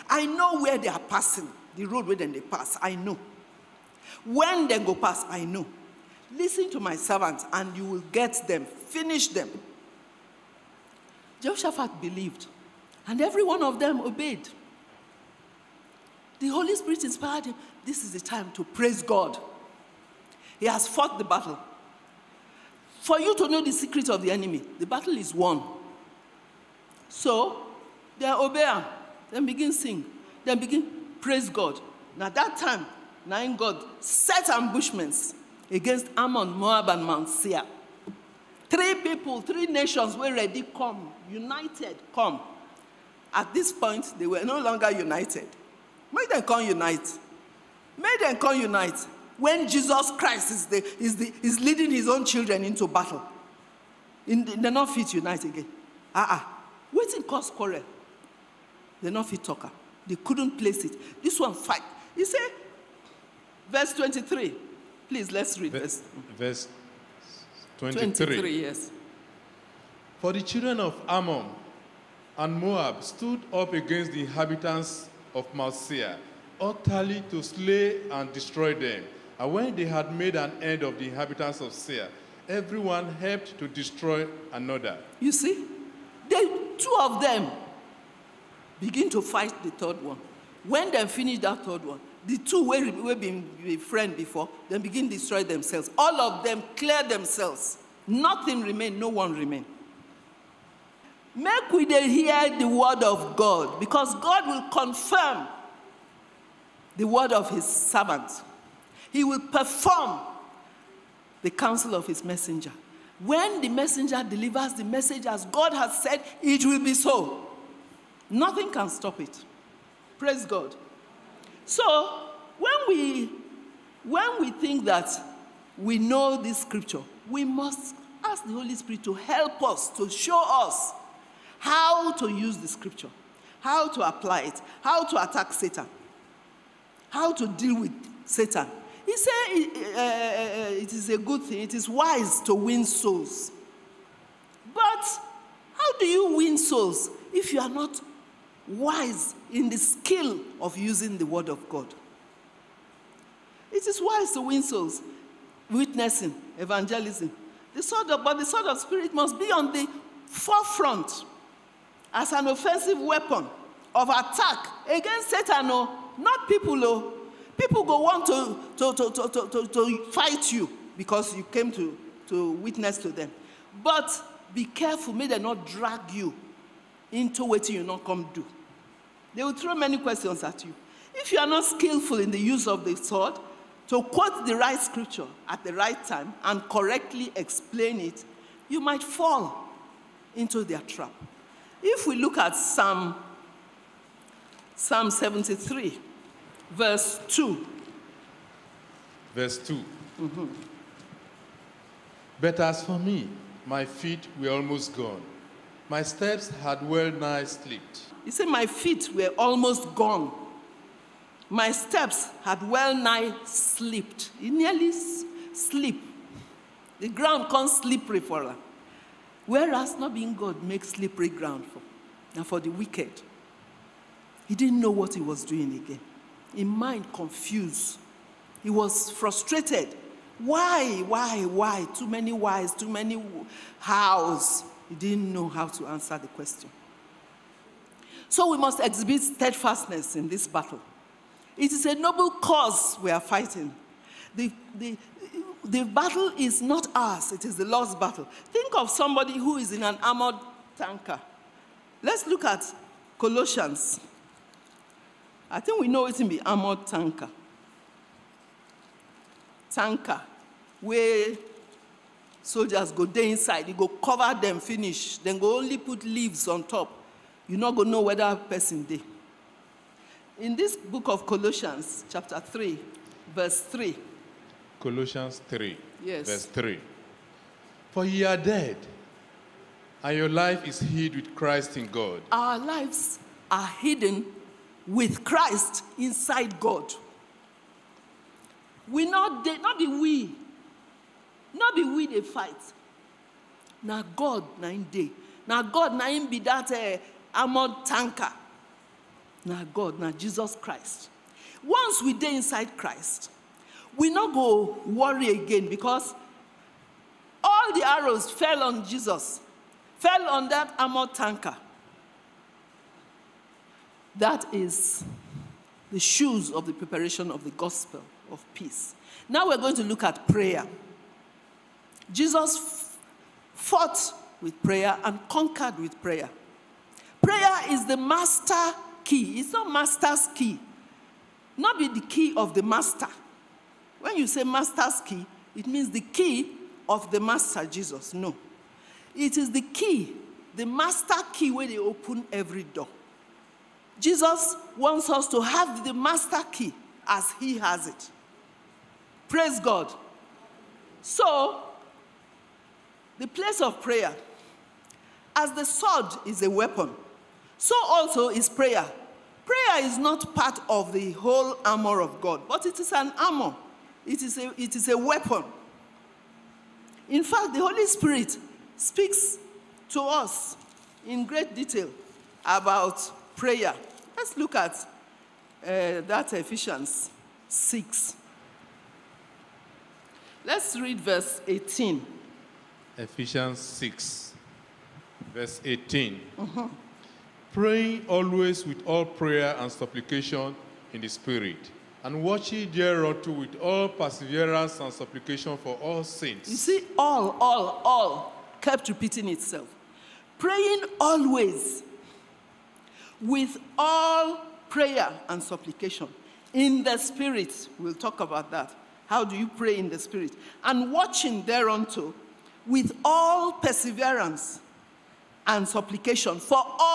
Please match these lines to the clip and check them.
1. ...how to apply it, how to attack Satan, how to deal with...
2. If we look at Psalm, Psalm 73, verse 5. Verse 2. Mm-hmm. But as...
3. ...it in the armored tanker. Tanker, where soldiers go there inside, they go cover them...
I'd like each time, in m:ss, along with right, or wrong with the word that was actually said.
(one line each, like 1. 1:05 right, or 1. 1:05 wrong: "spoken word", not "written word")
1. 2:13 right
2. 3:11 wrong: "2", not "5"
3. 4:16 right.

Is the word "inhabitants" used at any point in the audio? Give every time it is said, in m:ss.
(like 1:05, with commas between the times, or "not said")
1:14, 1:21.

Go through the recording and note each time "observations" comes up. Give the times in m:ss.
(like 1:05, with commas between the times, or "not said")
not said.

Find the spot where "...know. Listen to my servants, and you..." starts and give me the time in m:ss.
0:05.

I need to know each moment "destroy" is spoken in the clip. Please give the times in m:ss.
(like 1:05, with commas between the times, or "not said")
1:18, 1:23, 1:35.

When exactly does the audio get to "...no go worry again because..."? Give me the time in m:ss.
5:04.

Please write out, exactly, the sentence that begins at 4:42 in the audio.
Our lives are hidden with Christ inside God.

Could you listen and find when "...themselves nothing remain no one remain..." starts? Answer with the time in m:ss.
1:37.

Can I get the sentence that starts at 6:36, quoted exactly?
You see, all, all, all kept repeating itself.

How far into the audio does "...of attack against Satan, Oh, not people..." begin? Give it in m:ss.
2:43.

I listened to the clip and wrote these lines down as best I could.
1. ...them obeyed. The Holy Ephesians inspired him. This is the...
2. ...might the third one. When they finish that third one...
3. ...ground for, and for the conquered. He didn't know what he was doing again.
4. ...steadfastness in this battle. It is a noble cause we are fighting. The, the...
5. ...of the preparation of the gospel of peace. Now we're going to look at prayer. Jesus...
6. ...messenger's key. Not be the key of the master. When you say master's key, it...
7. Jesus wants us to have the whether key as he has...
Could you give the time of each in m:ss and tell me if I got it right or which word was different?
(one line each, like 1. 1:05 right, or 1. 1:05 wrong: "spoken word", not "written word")
1. 0:13 wrong: "Spirit", not "Ephesians"
2. 1:29 wrong: "fight", not "might"
3. 3:41 wrong: "wicked", not "conquered"
4. 3:59 right
5. 5:16 right
6. 5:29 wrong: "master", not "messenger"
7. 5:43 wrong: "master", not "whether".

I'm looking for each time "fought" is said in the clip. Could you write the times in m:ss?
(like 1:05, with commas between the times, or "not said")
0:20, 5:23.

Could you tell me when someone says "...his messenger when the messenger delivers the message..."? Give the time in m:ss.
1:52.